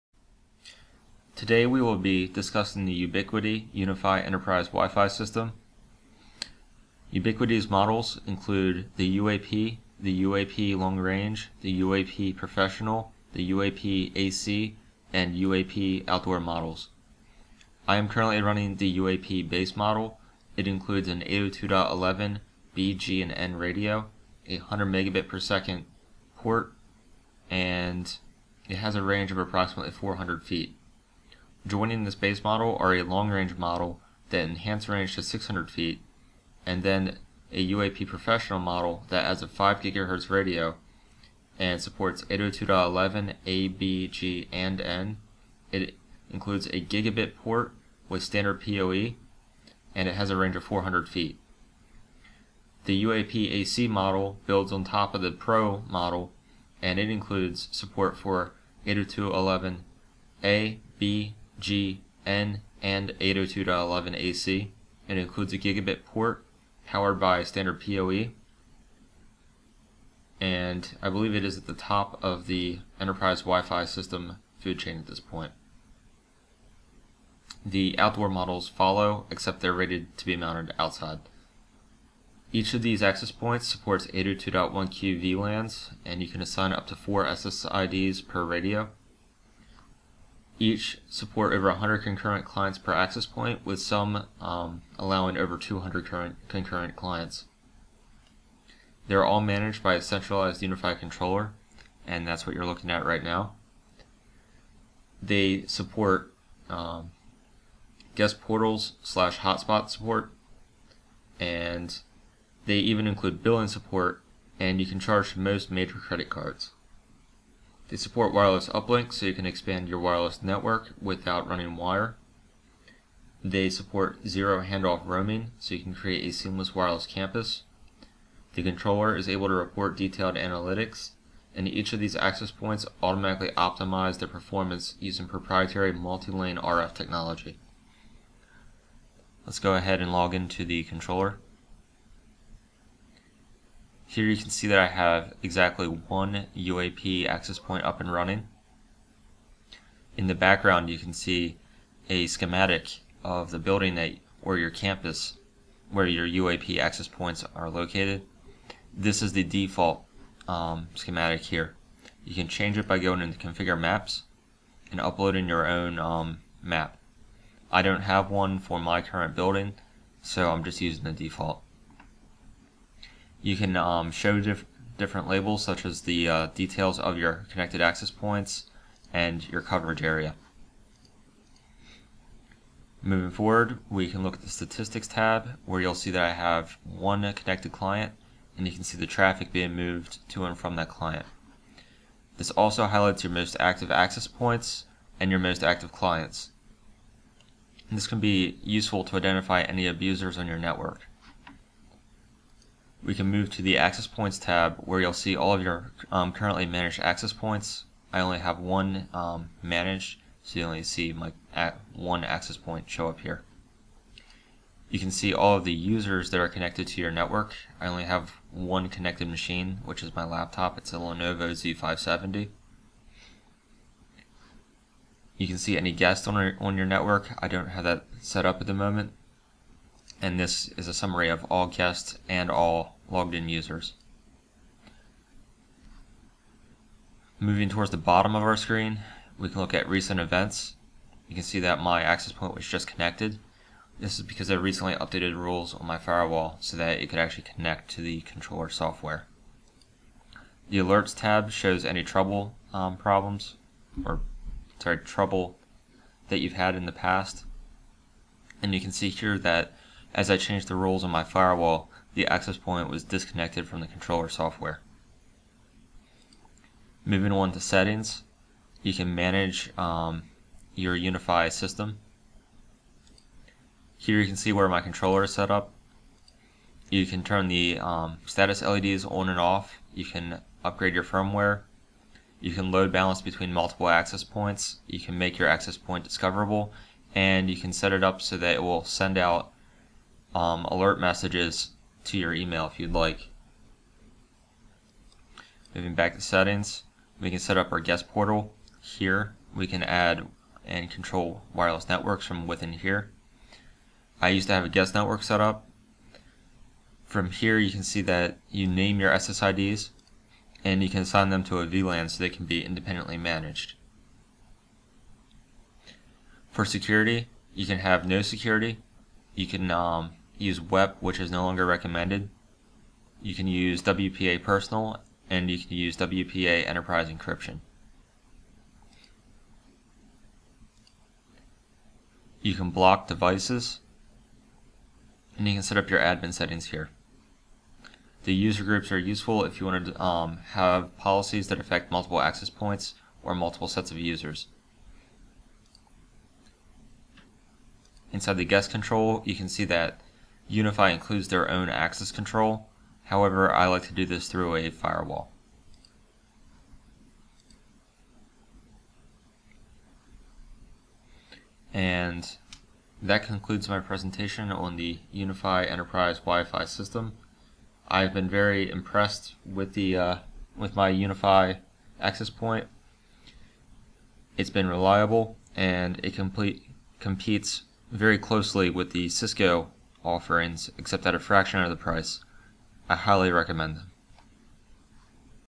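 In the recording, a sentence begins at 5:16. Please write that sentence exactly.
For security, you can have no security.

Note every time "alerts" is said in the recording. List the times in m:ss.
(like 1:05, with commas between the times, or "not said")
4:10, 4:50.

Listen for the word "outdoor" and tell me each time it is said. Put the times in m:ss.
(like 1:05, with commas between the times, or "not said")
0:16, 1:17.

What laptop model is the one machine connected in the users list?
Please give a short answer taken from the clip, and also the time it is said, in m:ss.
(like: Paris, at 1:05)
Lenovo Z570, at 3:40.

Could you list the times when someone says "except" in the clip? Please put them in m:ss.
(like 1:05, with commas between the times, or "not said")
1:19, 6:20.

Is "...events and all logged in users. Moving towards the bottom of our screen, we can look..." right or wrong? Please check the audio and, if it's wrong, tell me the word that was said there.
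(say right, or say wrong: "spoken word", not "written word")
wrong: "guests", not "events".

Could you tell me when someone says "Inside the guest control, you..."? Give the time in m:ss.
5:48.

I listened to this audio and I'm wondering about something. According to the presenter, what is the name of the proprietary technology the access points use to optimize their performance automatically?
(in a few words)
multi-lane RF technology.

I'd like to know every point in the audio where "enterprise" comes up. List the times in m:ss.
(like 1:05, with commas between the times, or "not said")
0:04, 1:12, 5:26, 6:05.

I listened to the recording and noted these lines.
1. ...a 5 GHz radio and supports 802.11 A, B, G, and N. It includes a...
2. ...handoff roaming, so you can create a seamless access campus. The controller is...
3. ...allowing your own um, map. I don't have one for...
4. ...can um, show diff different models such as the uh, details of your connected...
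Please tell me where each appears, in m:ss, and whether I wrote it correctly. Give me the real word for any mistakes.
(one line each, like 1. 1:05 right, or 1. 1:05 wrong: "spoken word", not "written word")
1. 0:39 right
2. 2:04 wrong: "wireless", not "access"
3. 2:44 wrong: "uploading", not "allowing"
4. 2:53 wrong: "labels", not "models".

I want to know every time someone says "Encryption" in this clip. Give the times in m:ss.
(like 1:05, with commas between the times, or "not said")
5:27.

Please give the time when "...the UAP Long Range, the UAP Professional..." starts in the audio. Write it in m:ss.
0:09.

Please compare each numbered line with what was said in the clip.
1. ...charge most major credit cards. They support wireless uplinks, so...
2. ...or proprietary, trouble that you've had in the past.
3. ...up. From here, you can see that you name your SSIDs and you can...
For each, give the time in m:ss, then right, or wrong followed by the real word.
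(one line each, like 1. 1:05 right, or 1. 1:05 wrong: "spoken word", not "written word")
1. 1:54 right
2. 4:14 wrong: "sorry", not "proprietary"
3. 5:05 right.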